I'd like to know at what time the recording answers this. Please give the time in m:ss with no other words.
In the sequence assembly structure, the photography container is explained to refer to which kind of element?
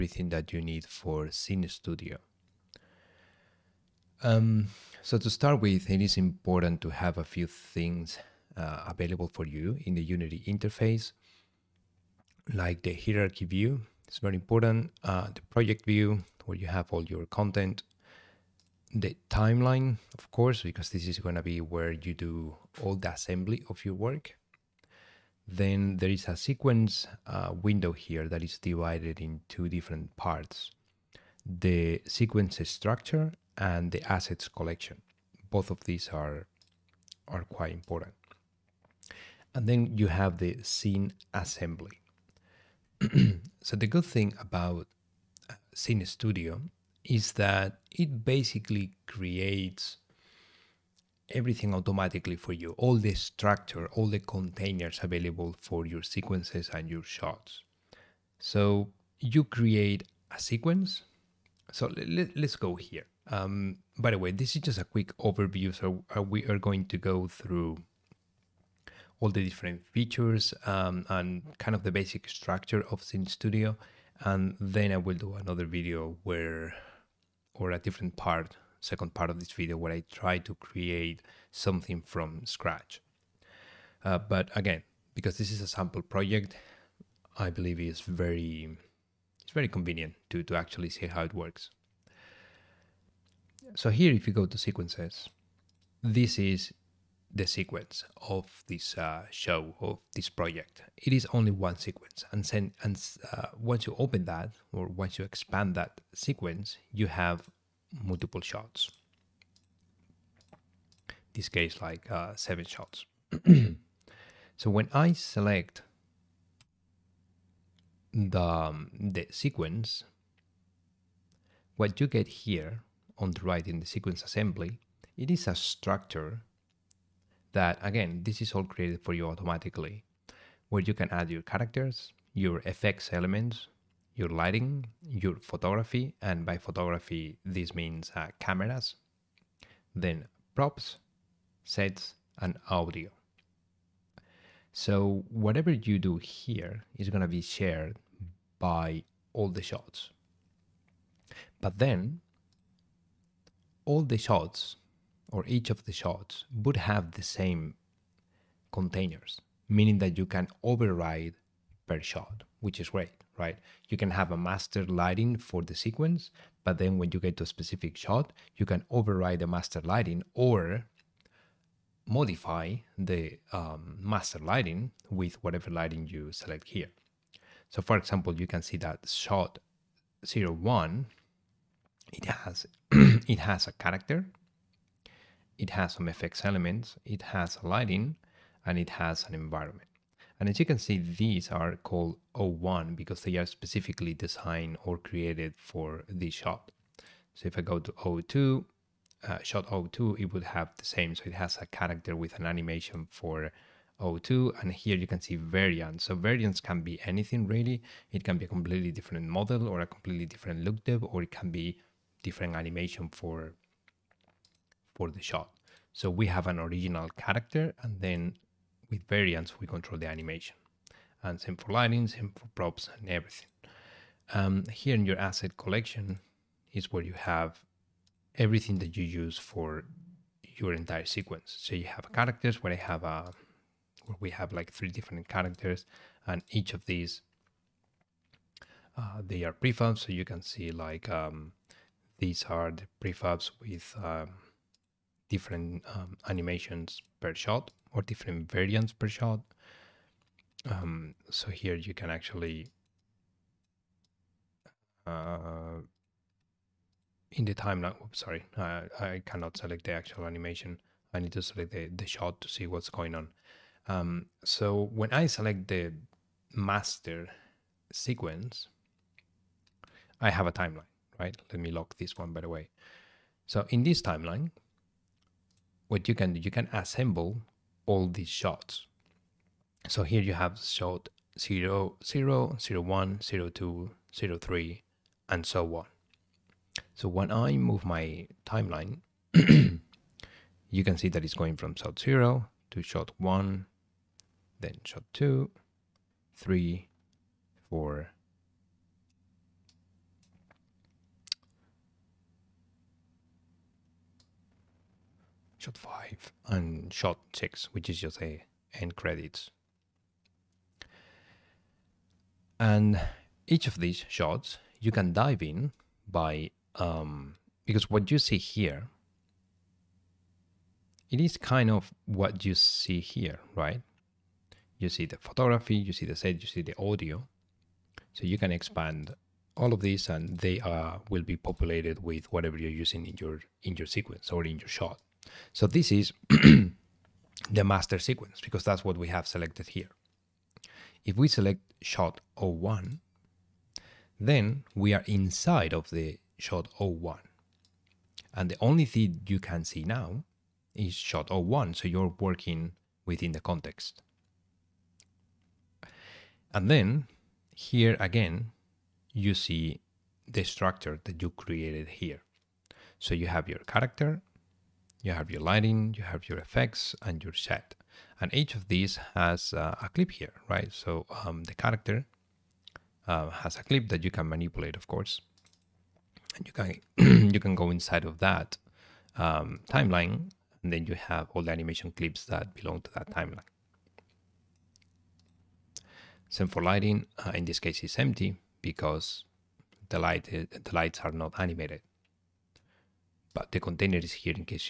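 2:18.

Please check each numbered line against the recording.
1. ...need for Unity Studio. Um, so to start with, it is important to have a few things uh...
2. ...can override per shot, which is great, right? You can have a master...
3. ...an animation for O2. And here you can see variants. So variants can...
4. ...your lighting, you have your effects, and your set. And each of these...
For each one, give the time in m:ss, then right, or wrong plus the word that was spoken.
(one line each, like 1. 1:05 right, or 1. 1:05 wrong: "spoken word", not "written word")
1. 0:00 wrong: "Cine", not "Unity"
2. 2:40 right
3. 3:22 right
4. 6:05 right.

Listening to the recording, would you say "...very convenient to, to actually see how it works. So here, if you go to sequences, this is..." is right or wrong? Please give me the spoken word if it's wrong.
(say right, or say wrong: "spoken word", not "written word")
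right.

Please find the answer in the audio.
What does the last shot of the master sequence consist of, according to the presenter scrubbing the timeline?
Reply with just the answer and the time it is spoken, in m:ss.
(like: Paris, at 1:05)
End credits, at 5:08.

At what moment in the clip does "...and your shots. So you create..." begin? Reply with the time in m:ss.
0:56.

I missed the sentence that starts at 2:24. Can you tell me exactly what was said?
So whatever you do here is going to be shared by all the shots.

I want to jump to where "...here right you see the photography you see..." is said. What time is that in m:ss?
5:23.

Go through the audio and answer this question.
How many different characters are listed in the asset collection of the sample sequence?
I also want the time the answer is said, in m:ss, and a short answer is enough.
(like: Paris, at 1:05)
3, at 3:54.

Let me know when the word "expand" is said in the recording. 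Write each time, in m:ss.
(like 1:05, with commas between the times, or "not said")
1:45, 5:28.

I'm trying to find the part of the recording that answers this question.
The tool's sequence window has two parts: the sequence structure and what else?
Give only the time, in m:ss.
0:33.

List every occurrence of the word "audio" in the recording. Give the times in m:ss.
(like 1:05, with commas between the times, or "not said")
2:22, 5:26.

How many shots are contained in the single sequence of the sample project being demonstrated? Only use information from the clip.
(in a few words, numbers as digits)
7.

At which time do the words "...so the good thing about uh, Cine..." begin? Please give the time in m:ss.
0:43.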